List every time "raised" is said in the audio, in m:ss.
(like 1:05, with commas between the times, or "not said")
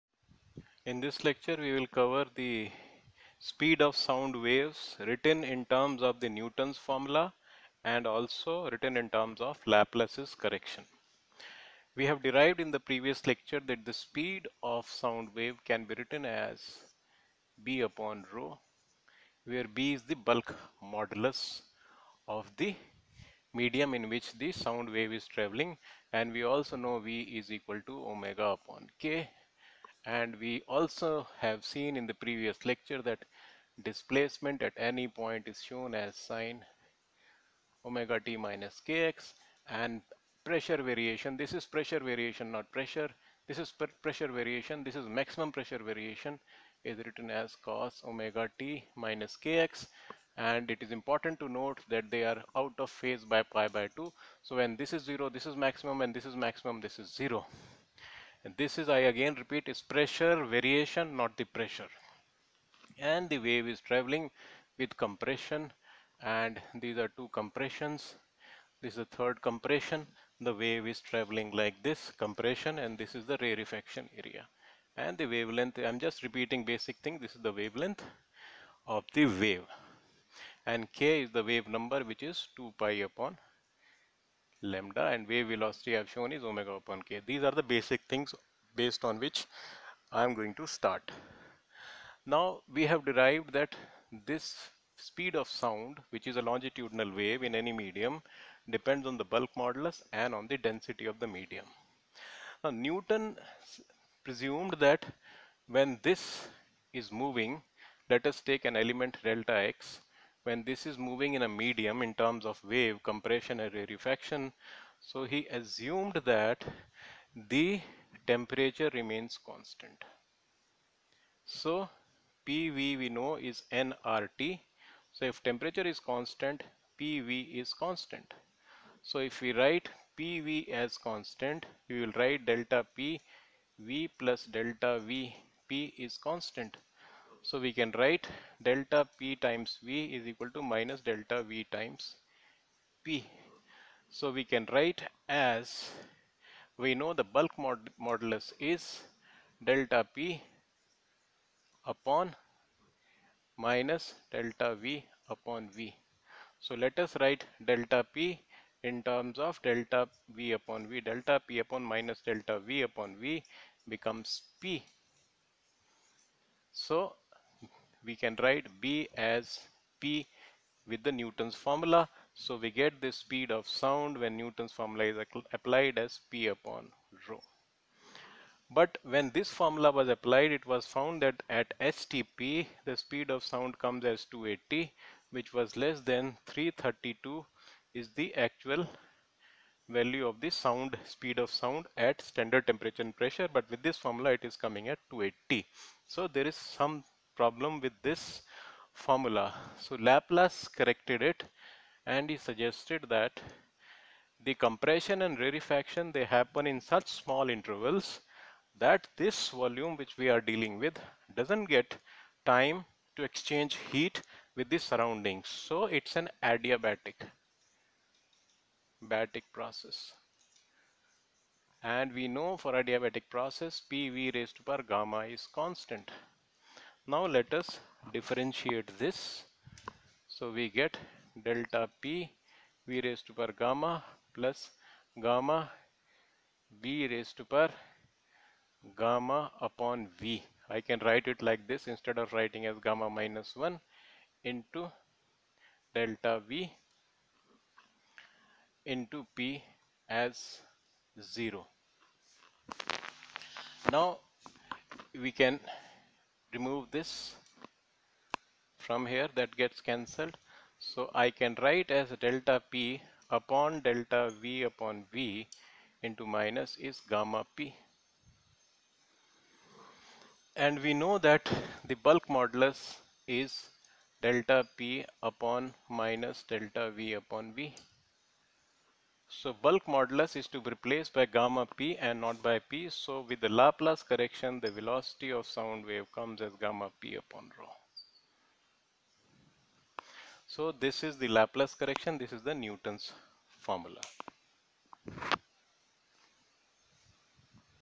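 3:44, 3:53, 3:57.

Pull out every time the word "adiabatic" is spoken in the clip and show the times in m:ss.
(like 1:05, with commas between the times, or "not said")
3:36, 3:42.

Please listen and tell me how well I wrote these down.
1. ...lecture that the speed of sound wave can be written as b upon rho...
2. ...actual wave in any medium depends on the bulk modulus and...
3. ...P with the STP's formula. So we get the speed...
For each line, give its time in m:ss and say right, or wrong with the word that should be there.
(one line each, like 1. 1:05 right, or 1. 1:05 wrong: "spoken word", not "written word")
1. 0:13 right
2. 1:36 wrong: "longitudinal", not "actual"
3. 2:49 wrong: "Newton", not "STP".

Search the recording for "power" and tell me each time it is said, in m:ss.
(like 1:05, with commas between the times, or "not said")
3:44, 3:53, 3:57.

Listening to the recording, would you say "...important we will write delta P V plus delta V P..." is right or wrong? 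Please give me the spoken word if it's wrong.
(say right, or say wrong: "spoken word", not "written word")
wrong: "constant", not "important".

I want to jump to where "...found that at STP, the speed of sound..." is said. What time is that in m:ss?
3:00.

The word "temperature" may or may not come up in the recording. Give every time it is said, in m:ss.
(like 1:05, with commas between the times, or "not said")
1:58, 2:05, 3:12.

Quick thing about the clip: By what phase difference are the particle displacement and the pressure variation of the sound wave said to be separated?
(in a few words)
pi by 2.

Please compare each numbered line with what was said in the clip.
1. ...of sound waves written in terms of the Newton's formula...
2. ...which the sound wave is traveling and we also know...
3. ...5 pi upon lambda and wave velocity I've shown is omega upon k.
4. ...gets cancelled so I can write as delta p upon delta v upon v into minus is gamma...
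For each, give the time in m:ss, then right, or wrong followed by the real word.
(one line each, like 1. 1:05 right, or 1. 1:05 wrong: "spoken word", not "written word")
1. 0:03 right
2. 0:24 right
3. 1:22 wrong: "2", not "5"
4. 4:19 right.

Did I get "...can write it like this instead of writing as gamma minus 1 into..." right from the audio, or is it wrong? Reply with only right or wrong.
right.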